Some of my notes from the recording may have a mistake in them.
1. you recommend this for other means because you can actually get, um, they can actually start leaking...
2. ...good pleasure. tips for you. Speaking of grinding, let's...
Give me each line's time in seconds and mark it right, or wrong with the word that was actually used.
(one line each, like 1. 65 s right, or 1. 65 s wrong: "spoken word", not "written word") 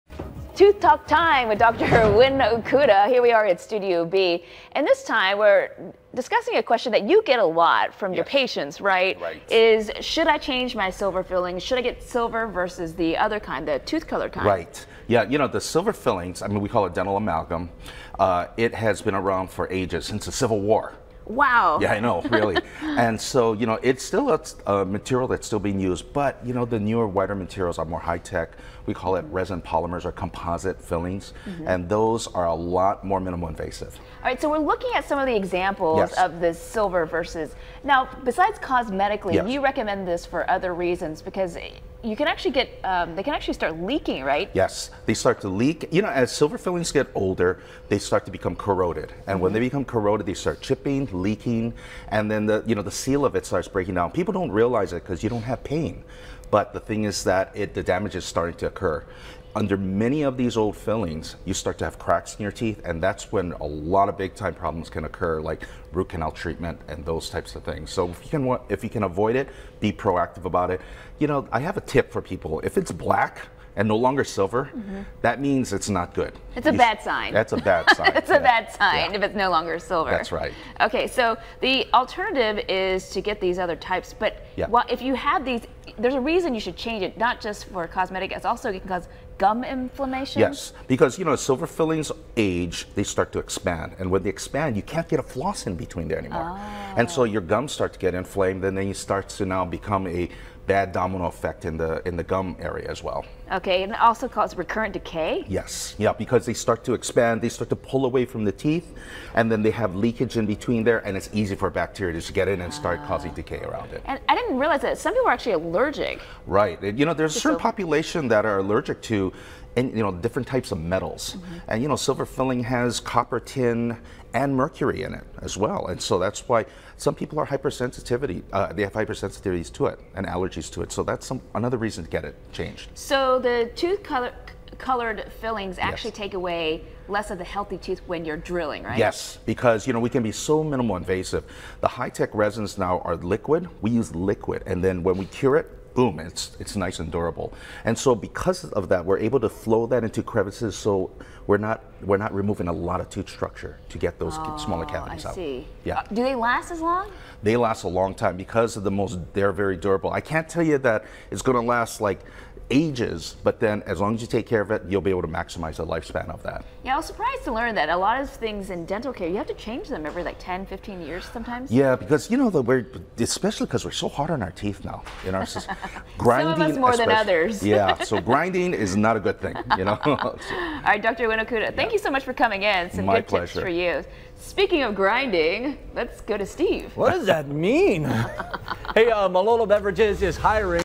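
1. 39 s wrong: "reasons", not "means"
2. 183 s right.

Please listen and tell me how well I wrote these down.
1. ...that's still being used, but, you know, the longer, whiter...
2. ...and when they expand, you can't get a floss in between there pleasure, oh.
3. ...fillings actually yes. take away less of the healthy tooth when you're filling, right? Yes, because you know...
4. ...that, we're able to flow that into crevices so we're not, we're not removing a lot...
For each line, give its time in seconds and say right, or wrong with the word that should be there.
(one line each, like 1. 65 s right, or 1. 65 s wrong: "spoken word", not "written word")
1. 25 s wrong: "newer", not "longer"
2. 93 s wrong: "anymore", not "pleasure"
3. 135 s wrong: "drilling", not "filling"
4. 148 s right.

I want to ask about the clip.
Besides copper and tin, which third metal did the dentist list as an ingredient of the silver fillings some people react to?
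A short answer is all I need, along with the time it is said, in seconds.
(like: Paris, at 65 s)
Mercury, at 124 s.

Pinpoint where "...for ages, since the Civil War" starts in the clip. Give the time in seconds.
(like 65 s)
19 s.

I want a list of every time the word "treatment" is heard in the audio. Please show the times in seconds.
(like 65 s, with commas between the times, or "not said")
66 s.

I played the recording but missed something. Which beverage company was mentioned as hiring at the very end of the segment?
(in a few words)
Malolo Beverages.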